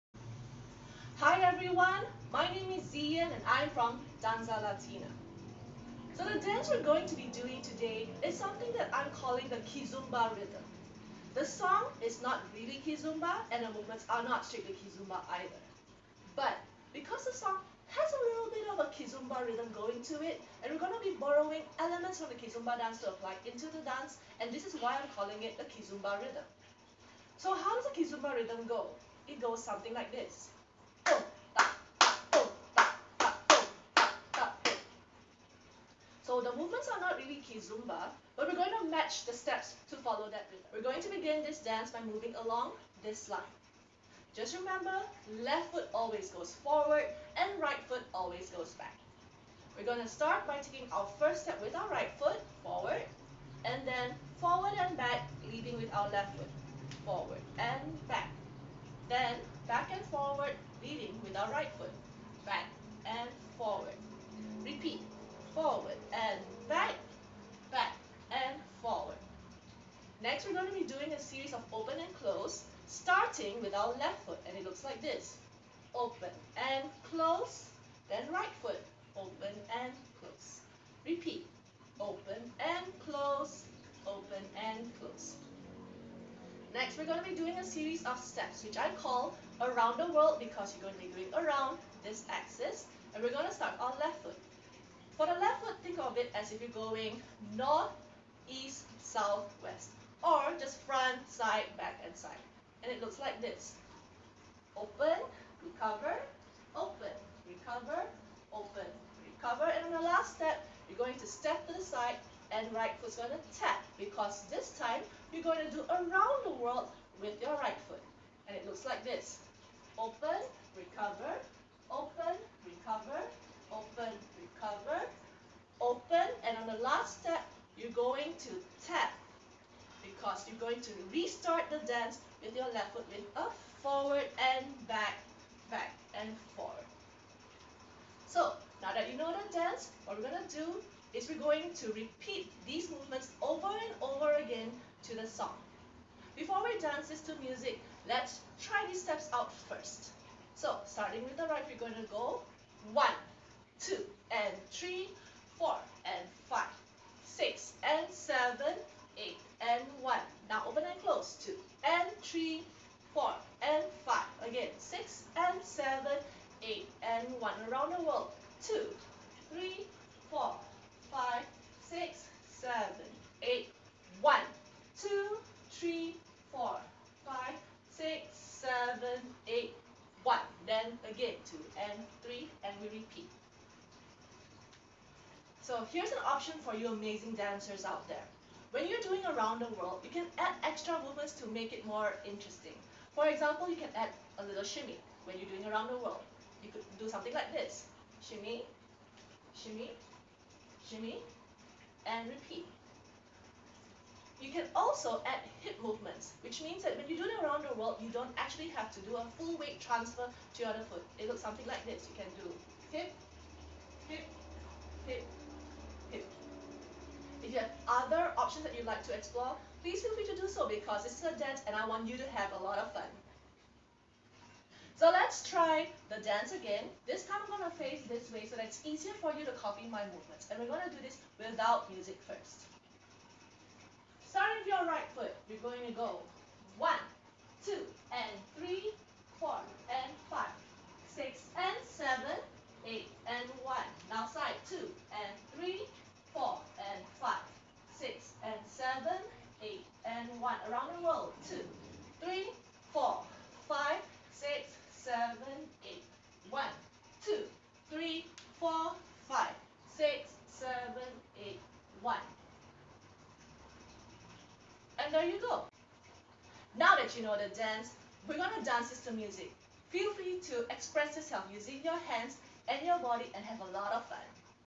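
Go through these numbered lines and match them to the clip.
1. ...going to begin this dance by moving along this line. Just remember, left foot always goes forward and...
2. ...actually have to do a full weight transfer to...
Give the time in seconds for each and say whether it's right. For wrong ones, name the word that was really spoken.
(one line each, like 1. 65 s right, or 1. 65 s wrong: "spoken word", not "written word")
1. 40 s right
2. 208 s right.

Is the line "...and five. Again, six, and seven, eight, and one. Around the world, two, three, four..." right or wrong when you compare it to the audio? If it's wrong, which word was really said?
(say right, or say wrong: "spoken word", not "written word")
right.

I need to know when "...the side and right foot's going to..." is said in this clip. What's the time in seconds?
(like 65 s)
111 s.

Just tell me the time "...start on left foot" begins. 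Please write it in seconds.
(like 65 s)
93 s.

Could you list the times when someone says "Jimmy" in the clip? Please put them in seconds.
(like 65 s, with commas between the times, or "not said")
200 s.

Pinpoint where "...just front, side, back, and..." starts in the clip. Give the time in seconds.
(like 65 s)
100 s.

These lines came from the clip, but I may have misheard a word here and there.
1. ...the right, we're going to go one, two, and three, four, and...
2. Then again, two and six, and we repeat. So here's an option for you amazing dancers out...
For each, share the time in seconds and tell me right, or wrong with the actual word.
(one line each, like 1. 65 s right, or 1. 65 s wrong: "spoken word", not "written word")
1. 151 s right
2. 180 s wrong: "three", not "six".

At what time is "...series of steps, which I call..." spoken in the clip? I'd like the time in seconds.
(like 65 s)
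87 s.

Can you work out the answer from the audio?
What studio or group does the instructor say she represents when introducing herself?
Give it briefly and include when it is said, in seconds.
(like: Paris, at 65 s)
Dansza Latina, at 4 s.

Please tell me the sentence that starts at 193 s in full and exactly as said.
For example, you can add a little shimmy when you're doing around the world.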